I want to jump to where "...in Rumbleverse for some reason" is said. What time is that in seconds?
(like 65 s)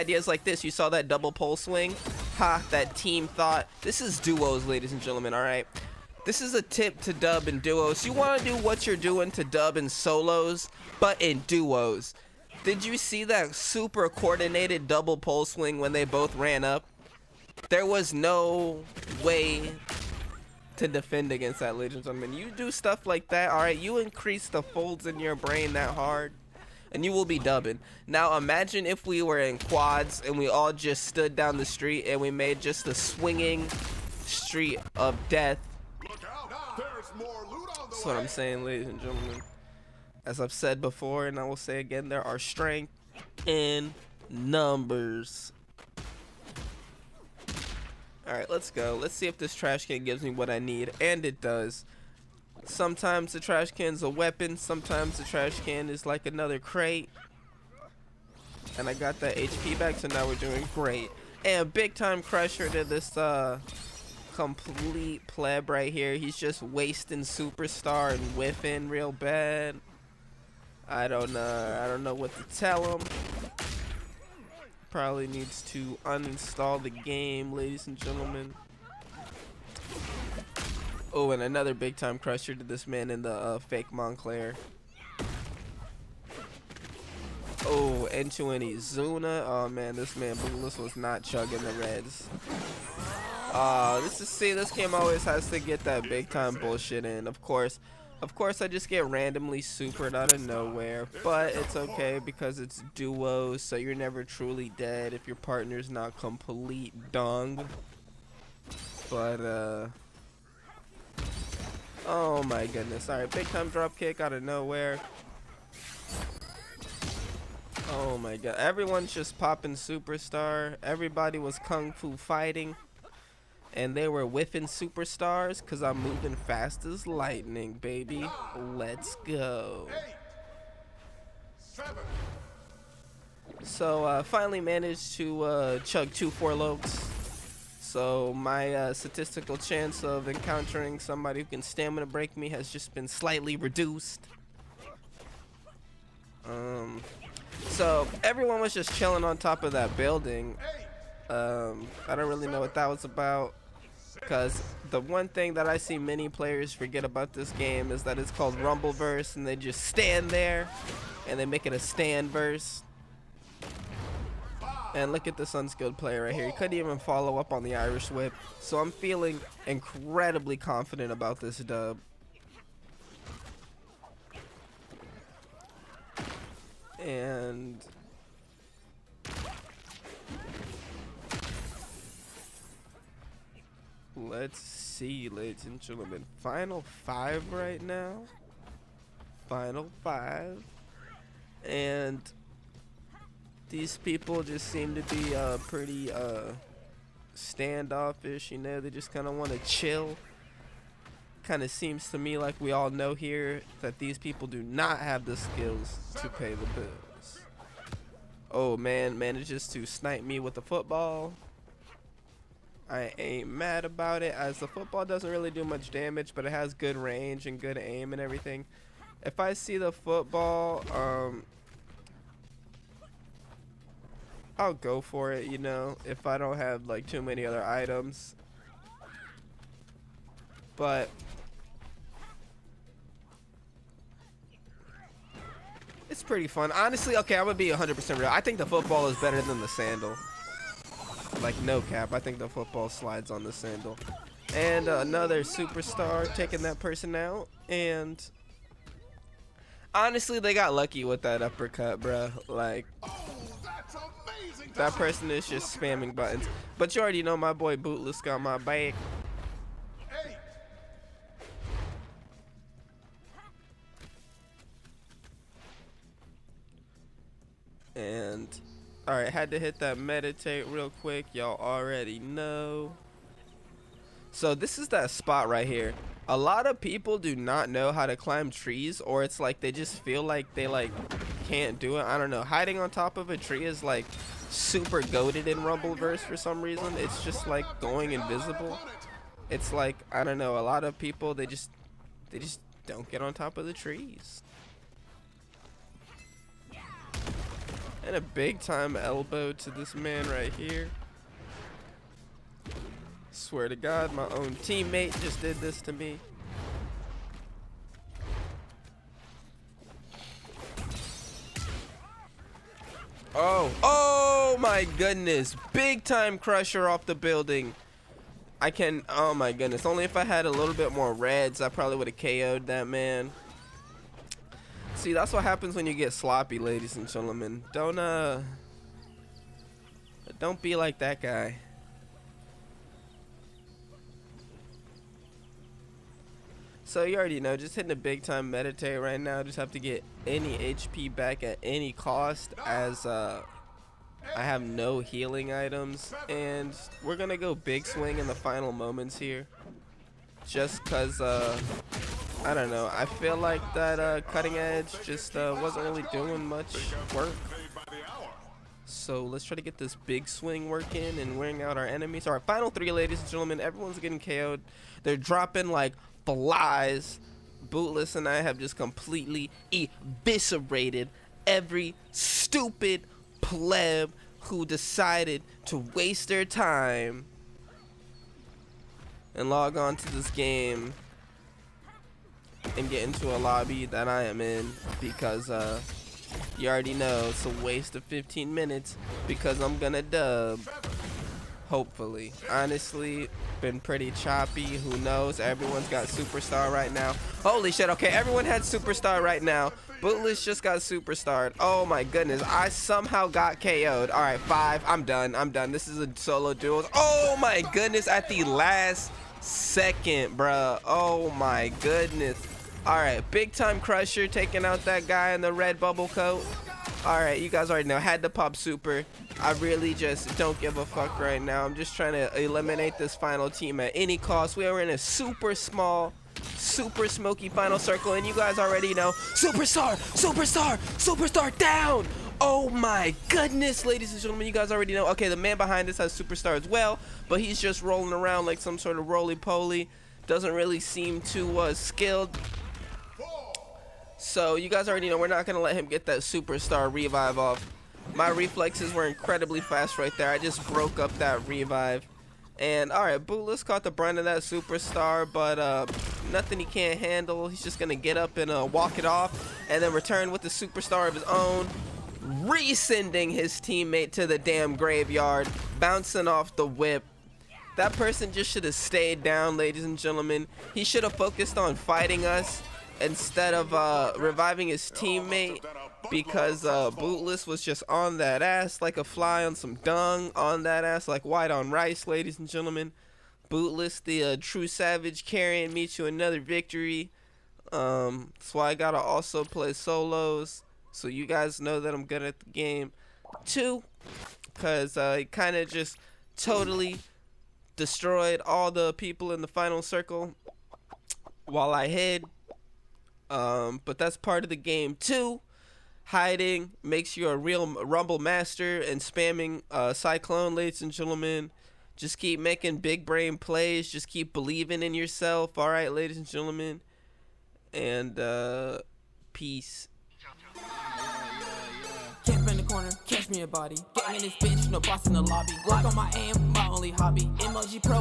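285 s.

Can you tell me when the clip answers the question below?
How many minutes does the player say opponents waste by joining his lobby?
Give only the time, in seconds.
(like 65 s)
388 s.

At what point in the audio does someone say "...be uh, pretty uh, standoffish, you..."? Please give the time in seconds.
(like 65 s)
195 s.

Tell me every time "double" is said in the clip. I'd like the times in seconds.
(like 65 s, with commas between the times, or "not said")
1 s, 14 s.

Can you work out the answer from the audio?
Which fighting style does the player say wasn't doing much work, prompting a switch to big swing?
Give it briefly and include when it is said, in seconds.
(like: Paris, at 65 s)
Cutting edge, at 354 s.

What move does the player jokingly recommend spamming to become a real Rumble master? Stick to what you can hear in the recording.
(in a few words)
Cyclone.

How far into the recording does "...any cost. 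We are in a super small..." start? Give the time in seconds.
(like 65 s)
423 s.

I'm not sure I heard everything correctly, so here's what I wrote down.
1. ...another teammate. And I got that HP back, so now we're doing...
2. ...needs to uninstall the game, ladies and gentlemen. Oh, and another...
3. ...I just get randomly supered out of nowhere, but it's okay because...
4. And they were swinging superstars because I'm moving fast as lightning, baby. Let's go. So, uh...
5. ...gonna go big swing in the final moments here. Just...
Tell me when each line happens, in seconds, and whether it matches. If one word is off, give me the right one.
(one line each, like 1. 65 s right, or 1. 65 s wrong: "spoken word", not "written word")
1. 56 s wrong: "crate", not "teammate"
2. 75 s right
3. 98 s right
4. 123 s wrong: "whiffing", not "swinging"
5. 347 s right.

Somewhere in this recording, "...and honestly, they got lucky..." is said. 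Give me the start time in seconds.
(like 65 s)
247 s.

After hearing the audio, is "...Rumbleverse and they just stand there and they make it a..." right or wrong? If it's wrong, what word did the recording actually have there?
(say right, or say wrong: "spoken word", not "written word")
right.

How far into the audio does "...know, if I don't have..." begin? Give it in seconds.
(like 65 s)
225 s.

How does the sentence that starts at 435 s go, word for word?
Okay, the man behind this has superstar as well, but he's just rolling around like some sort of roly-poly.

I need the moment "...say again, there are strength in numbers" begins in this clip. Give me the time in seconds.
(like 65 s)
41 s.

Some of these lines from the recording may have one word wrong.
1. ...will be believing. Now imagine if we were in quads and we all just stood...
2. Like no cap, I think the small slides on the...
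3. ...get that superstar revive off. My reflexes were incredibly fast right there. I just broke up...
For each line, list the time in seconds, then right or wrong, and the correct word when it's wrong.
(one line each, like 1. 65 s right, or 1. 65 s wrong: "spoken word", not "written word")
1. 27 s wrong: "dubbing", not "believing"
2. 241 s wrong: "football", not "small"
3. 445 s right.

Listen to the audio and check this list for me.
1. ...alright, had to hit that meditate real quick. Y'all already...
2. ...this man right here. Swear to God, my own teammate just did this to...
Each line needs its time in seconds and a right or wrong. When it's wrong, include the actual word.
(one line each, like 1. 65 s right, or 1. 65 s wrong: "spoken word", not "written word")
1. 269 s right
2. 299 s right.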